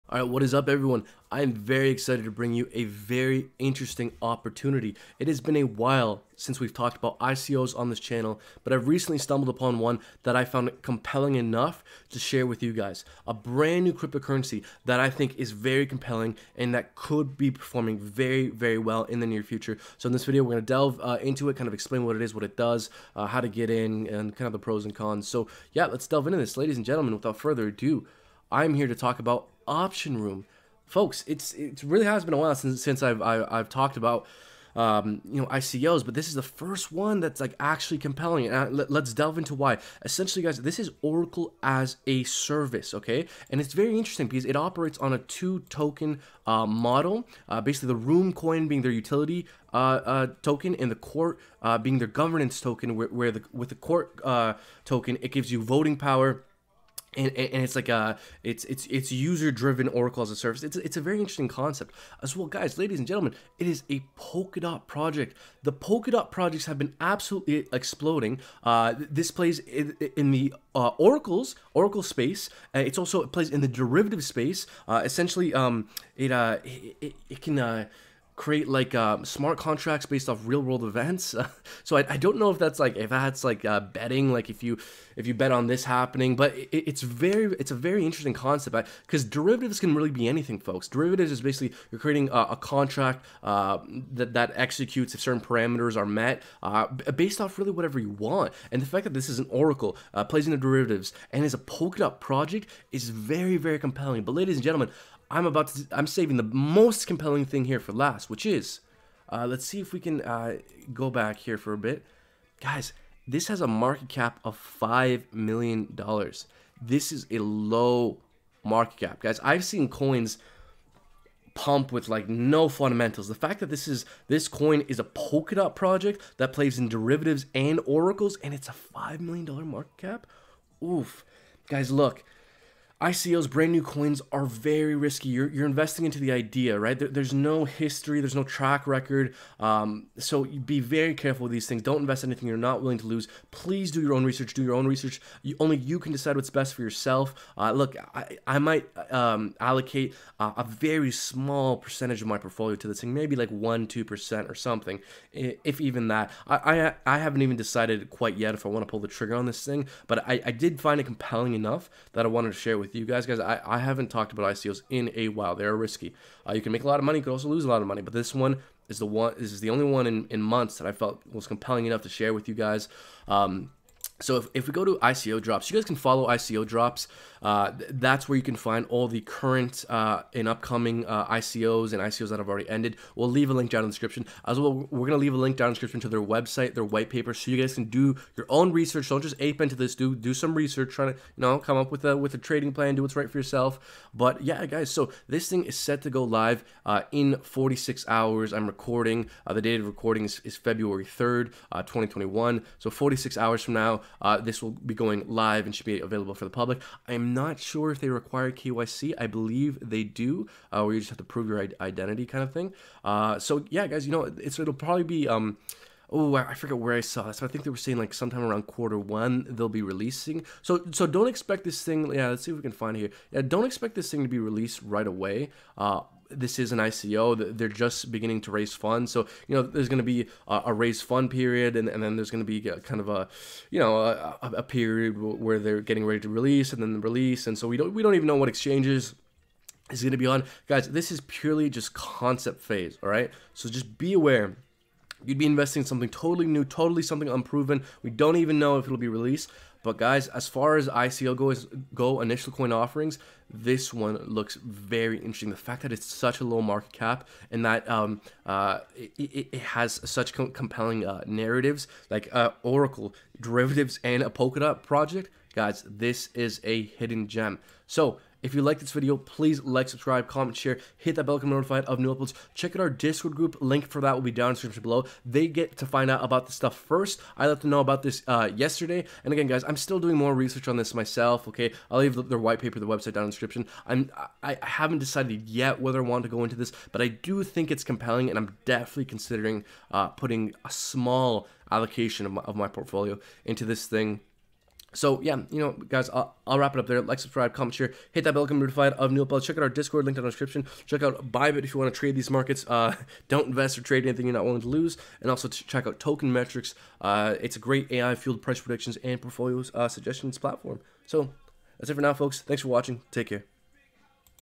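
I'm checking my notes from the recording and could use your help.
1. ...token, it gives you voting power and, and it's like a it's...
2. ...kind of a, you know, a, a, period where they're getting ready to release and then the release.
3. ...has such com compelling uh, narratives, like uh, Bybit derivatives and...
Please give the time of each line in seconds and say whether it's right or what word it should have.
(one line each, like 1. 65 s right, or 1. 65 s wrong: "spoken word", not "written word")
1. 54 s right
2. 232 s right
3. 259 s wrong: "Oracle", not "Bybit".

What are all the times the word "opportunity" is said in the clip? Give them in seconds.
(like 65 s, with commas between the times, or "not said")
4 s.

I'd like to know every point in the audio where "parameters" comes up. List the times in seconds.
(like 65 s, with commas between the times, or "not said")
95 s.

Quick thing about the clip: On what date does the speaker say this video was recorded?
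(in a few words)
February 3rd, 2021.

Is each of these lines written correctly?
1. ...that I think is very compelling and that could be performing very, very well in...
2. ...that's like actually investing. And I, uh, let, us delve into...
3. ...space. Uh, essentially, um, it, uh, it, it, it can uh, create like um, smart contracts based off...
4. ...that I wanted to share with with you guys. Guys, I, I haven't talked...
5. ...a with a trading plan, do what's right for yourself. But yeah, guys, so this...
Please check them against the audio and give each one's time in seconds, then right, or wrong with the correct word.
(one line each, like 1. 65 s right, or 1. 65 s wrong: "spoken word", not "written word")
1. 14 s right
2. 37 s wrong: "compelling", not "investing"
3. 74 s right
4. 162 s right
5. 192 s right.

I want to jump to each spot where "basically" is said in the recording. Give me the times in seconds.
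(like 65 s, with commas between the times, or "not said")
47 s, 91 s.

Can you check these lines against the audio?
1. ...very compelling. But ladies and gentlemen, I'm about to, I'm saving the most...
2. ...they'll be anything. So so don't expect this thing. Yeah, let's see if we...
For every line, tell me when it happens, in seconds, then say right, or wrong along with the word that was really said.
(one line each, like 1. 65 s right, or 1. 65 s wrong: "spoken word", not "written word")
1. 103 s right
2. 219 s wrong: "releasing", not "anything".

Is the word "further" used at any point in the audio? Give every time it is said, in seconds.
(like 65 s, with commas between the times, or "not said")
27 s.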